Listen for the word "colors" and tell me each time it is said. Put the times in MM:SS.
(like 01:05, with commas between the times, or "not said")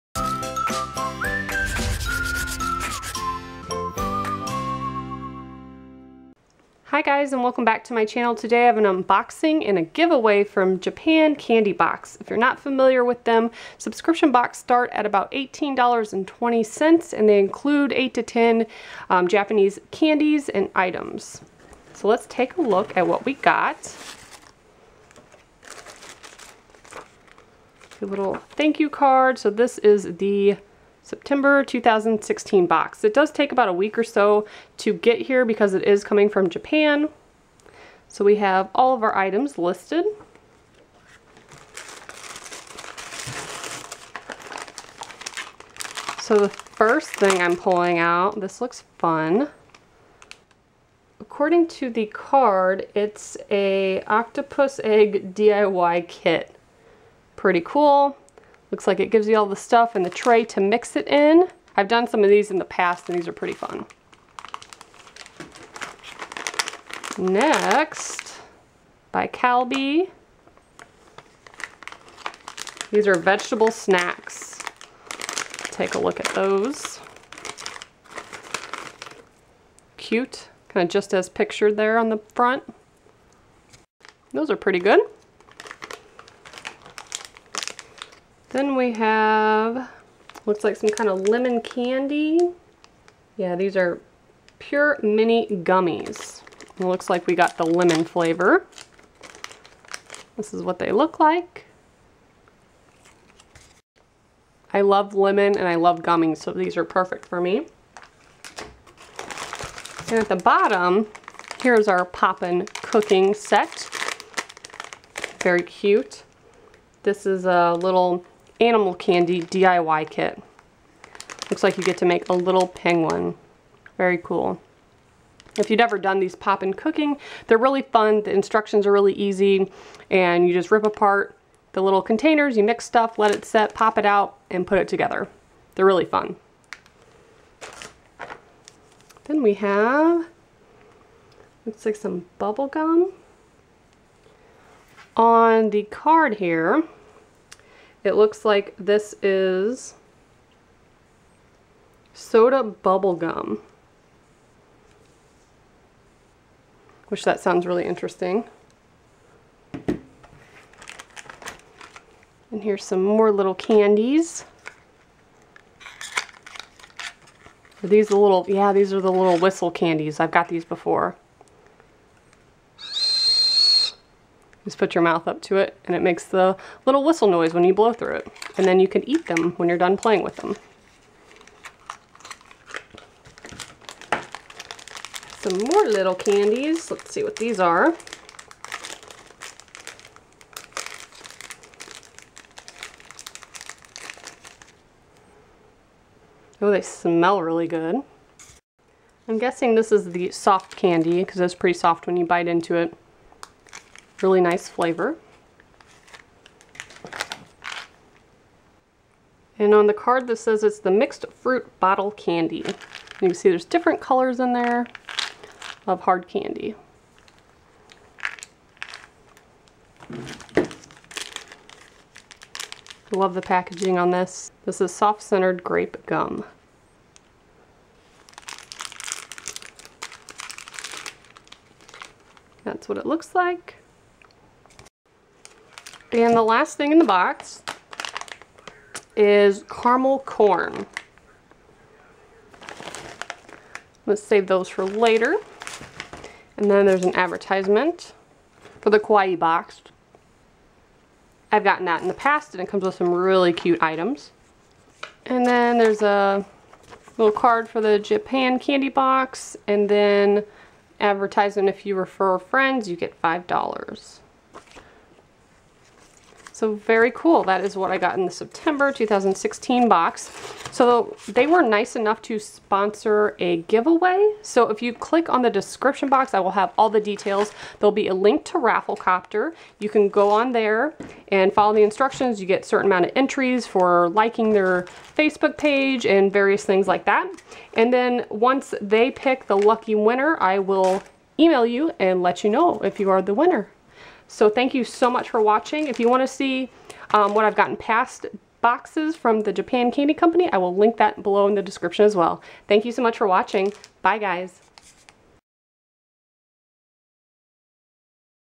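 03:34.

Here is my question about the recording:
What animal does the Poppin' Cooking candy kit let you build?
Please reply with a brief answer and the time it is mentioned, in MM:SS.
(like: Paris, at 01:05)
Penguin, at 02:02.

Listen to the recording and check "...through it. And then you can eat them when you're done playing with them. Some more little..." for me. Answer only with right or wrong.
right.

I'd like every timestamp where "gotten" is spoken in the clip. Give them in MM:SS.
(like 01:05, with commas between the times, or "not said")
04:11, 04:57.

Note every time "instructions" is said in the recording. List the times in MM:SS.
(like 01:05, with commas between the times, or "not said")
02:08, 04:41.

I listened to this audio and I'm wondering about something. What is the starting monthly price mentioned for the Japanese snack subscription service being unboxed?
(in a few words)
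$18.20.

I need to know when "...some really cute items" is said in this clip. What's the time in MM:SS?
04:12.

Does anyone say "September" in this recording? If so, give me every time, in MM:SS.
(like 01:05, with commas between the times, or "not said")
00:31, 04:28.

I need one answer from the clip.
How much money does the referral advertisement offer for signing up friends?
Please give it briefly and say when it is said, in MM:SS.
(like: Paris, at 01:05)
$5, at 04:23.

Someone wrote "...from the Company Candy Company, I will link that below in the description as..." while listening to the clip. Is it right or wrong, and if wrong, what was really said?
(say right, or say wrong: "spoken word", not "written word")
wrong: "Japan", not "Company".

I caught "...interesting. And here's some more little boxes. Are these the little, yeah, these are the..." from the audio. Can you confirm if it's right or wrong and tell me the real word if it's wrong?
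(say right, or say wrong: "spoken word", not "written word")
wrong: "candies", not "boxes".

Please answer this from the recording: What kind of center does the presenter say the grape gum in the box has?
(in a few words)
Soft-centered.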